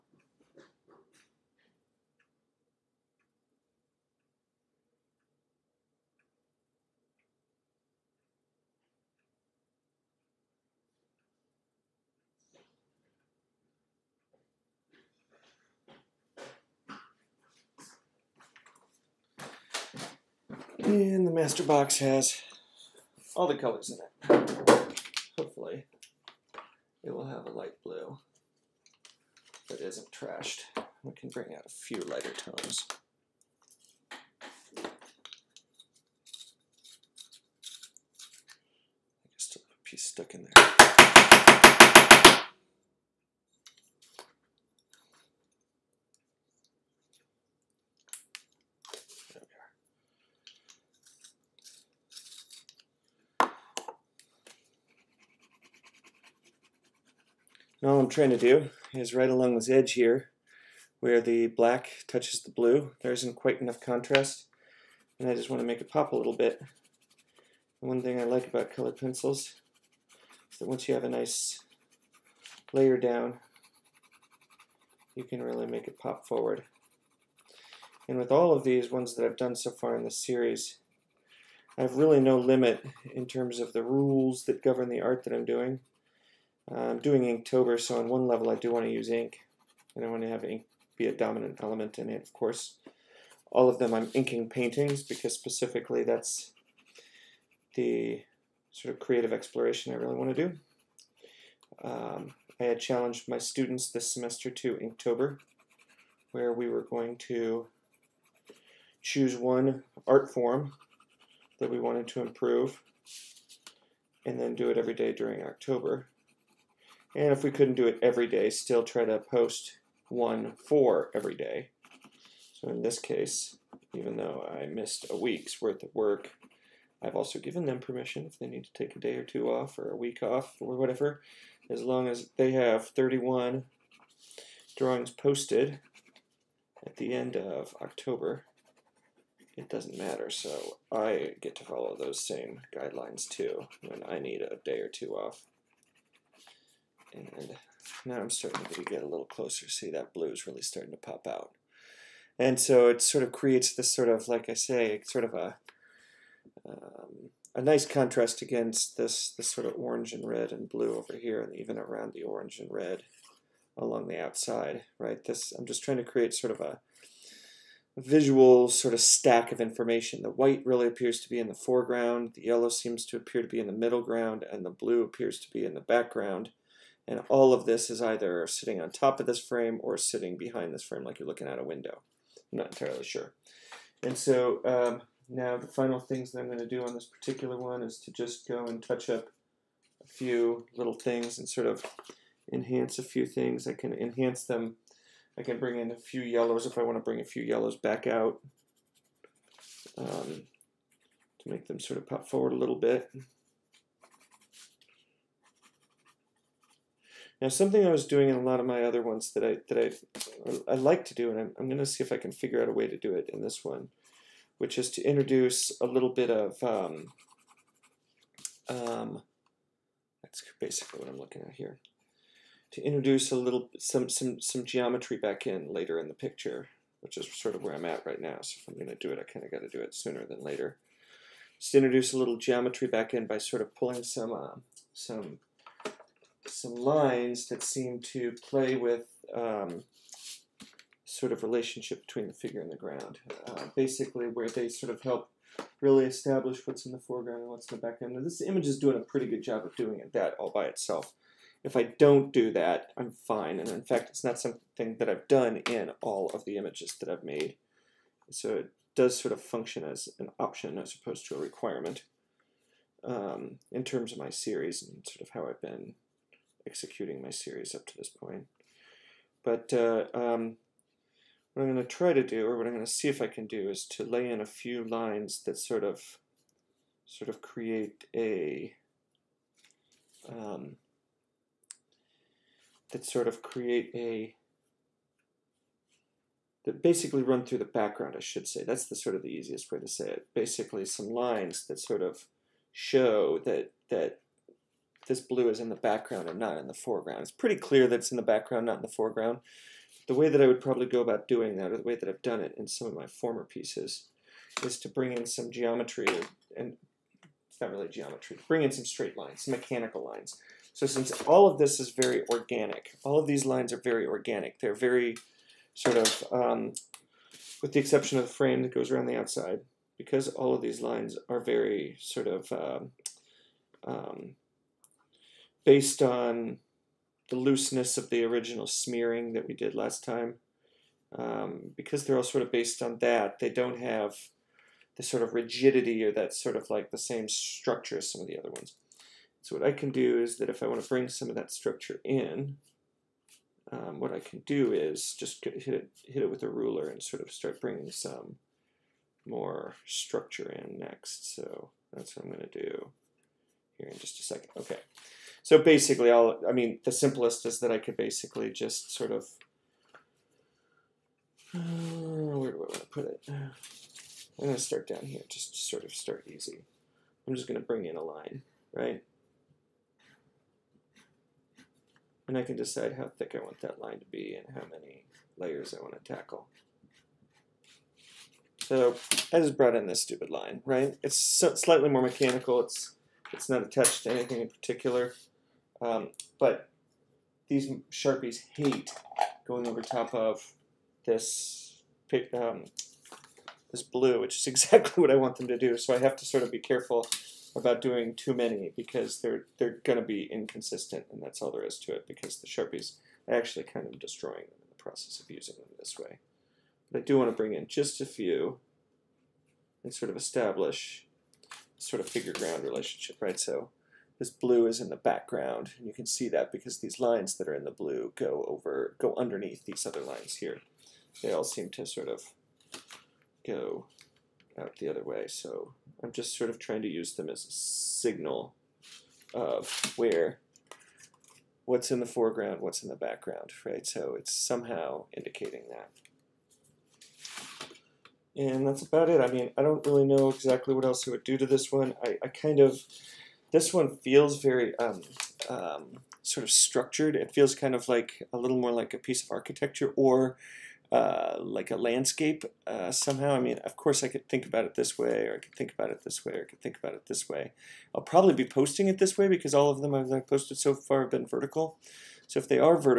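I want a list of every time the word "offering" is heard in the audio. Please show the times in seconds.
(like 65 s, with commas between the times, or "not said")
not said.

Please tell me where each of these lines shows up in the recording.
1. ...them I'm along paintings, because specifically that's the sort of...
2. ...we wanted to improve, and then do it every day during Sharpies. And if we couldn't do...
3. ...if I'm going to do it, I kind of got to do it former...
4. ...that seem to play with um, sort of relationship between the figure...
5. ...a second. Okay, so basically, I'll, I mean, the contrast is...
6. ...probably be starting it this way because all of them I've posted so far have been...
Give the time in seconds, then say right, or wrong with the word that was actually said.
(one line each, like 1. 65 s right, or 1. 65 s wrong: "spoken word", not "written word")
1. 93 s wrong: "inking", not "along"
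2. 111 s wrong: "October", not "Sharpies"
3. 228 s wrong: "sooner", not "former"
4. 237 s right
5. 354 s wrong: "simplest", not "contrast"
6. 458 s wrong: "posting", not "starting".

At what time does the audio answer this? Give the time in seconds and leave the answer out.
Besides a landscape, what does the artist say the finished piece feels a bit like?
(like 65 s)
448 s.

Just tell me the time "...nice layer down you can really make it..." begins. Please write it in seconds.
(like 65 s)
71 s.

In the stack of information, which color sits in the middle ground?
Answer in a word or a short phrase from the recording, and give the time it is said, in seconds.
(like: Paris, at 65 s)
Yellow, at 172 s.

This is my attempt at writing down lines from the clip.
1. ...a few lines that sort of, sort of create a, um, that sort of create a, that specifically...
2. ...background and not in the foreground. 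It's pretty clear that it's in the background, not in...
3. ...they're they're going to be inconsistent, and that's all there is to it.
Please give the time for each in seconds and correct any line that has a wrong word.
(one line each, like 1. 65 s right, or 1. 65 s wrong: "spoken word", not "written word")
1. 274 s wrong: "basically", not "specifically"
2. 295 s right
3. 399 s right.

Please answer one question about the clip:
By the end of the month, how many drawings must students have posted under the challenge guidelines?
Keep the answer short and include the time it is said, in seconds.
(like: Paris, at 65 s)
31, at 132 s.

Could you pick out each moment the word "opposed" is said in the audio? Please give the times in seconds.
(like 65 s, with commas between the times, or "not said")
260 s.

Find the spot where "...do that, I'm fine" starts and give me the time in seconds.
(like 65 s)
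252 s.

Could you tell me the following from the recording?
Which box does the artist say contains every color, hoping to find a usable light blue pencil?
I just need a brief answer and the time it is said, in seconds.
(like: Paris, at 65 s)
The master box, at 21 s.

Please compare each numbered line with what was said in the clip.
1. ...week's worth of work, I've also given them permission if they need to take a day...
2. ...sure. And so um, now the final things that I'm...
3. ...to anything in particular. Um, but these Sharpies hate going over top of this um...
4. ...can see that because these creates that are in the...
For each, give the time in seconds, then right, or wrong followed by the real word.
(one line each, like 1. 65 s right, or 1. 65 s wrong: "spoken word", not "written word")
1. 125 s right
2. 183 s right
3. 384 s right
4. 415 s wrong: "lines", not "creates".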